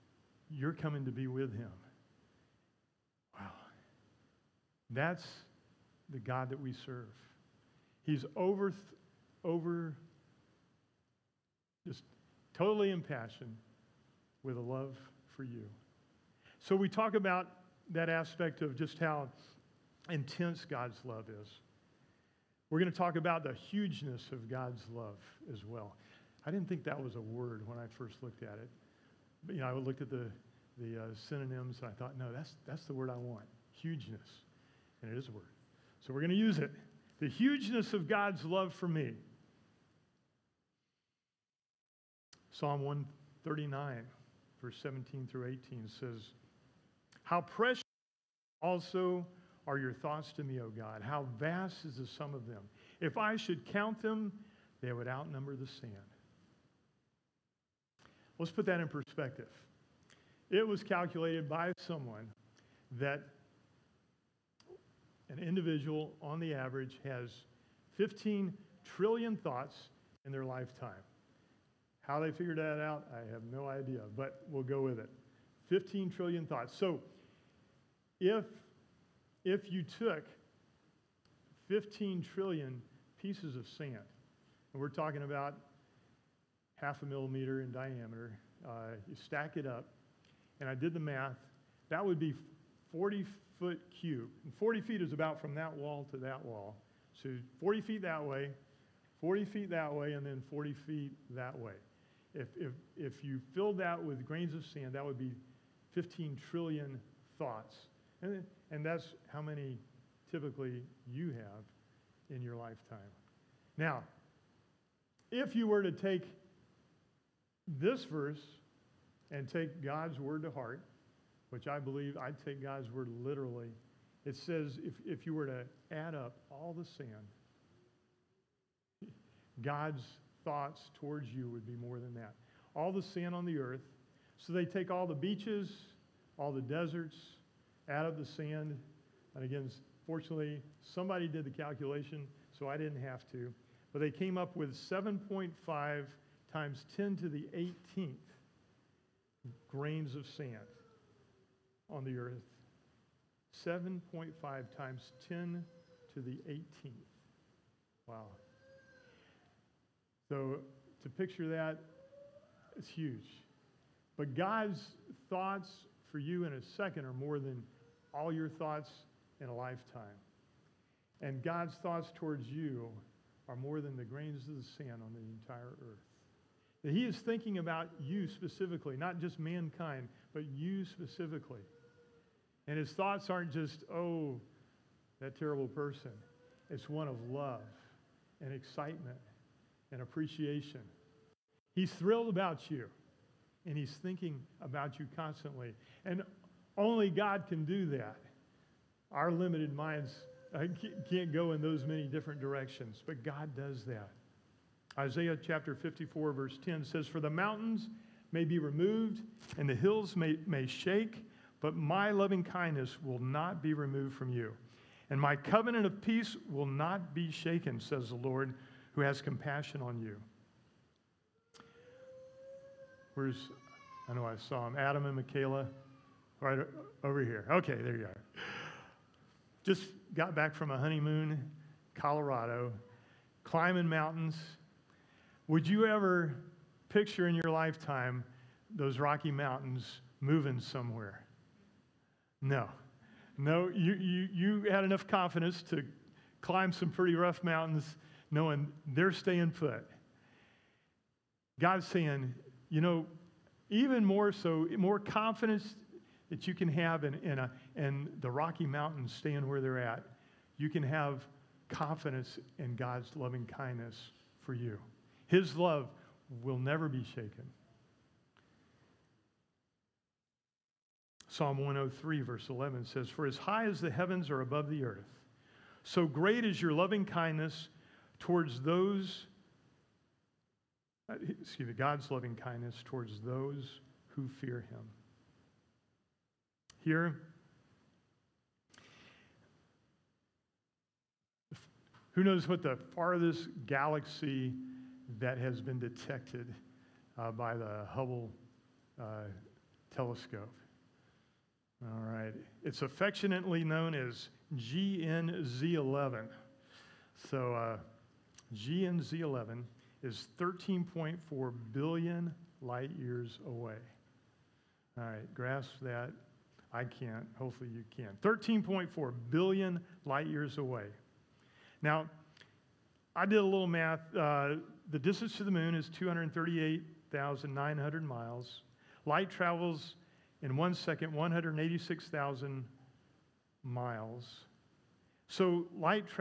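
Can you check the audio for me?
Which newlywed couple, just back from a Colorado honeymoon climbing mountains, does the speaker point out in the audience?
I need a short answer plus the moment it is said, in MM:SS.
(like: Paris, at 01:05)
Adam and Michaela, at 03:44.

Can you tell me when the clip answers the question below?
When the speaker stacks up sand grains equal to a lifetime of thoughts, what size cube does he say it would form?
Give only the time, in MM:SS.
01:32.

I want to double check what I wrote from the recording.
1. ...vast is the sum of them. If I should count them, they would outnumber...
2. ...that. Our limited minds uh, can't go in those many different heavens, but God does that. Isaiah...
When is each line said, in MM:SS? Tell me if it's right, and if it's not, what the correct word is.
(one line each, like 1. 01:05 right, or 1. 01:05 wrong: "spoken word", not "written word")
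1. 00:51 right
2. 03:17 wrong: "directions", not "heavens".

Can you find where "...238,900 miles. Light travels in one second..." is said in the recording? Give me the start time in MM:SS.
05:25.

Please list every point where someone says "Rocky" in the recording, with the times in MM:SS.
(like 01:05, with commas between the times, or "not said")
03:58, 04:18.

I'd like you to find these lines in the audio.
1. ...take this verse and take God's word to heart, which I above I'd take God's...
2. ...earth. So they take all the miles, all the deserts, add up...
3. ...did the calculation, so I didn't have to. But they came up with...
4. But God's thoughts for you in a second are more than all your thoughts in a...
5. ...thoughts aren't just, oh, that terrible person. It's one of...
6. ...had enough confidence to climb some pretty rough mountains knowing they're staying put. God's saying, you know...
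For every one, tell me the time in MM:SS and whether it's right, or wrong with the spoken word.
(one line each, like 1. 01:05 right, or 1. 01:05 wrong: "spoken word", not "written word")
1. 01:55 wrong: "believe", not "above"
2. 02:13 wrong: "beaches", not "miles"
3. 02:21 right
4. 02:44 right
5. 03:02 right
6. 04:04 right.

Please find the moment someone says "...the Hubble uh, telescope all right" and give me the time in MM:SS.
04:57.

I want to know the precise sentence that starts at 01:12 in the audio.
How they figured that out, I have no idea, but we'll go with it.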